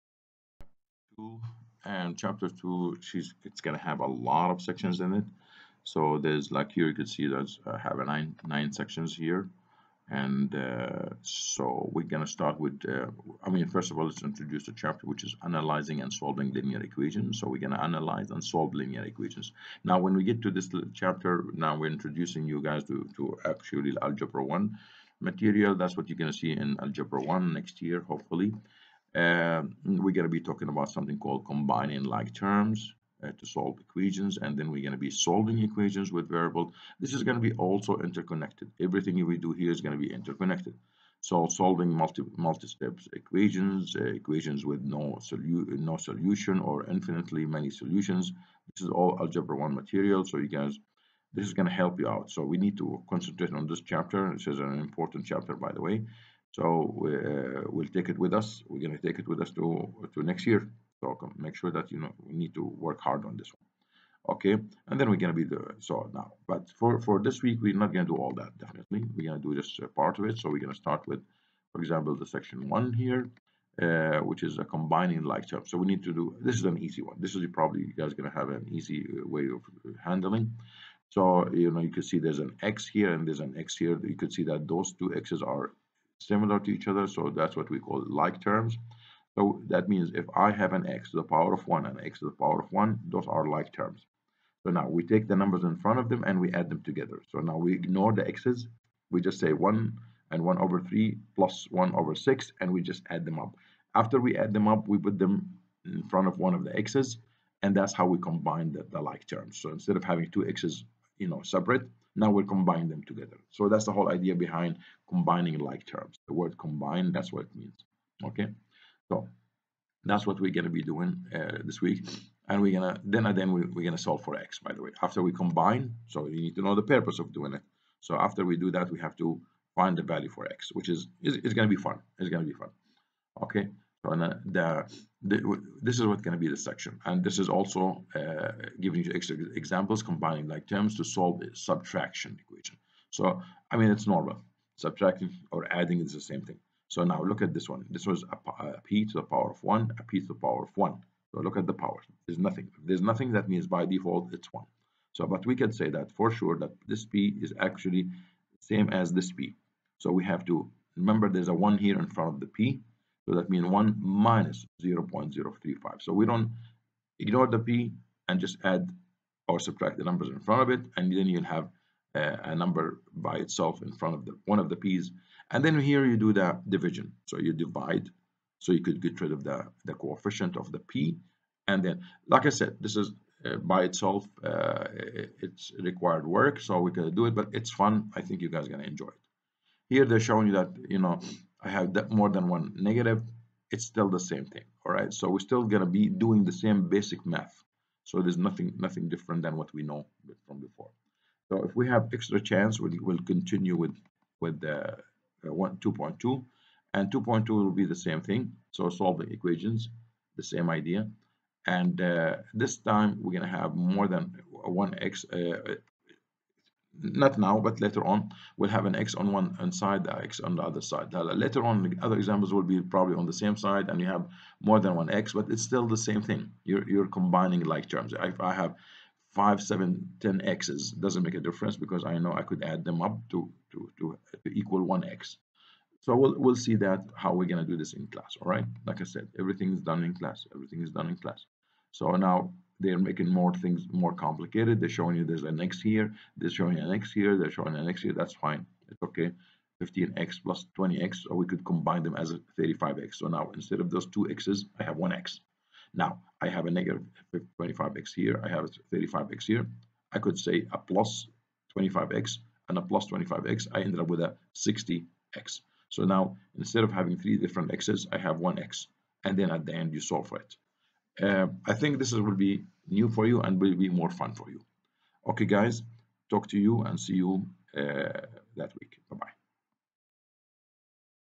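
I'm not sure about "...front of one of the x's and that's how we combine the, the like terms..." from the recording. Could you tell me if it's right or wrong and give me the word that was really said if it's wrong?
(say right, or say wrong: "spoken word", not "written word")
right.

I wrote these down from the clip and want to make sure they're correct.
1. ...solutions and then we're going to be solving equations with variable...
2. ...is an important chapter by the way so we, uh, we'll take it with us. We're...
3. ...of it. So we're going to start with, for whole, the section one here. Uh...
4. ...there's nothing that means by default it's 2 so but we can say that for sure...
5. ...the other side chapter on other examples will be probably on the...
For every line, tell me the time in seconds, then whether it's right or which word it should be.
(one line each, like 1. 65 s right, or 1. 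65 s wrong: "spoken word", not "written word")
1. 33 s wrong: "equations", not "solutions"
2. 54 s right
3. 70 s wrong: "example", not "whole"
4. 152 s wrong: "1", not "2"
5. 220 s wrong: "later", not "chapter".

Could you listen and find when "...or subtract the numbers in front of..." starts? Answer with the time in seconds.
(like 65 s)
169 s.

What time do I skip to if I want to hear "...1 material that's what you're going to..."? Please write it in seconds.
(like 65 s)
24 s.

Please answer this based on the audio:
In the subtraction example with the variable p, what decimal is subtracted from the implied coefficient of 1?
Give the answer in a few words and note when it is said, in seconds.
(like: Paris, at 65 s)
0.035, at 164 s.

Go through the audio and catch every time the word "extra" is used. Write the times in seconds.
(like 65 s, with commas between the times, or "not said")
139 s, 202 s.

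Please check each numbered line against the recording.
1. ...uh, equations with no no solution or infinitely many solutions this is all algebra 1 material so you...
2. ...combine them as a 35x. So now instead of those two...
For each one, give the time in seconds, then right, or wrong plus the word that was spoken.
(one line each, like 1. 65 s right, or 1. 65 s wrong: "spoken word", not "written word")
1. 43 s right
2. 251 s right.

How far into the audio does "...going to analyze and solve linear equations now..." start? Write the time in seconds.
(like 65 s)
17 s.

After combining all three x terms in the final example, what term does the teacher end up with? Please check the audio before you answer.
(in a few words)
60x.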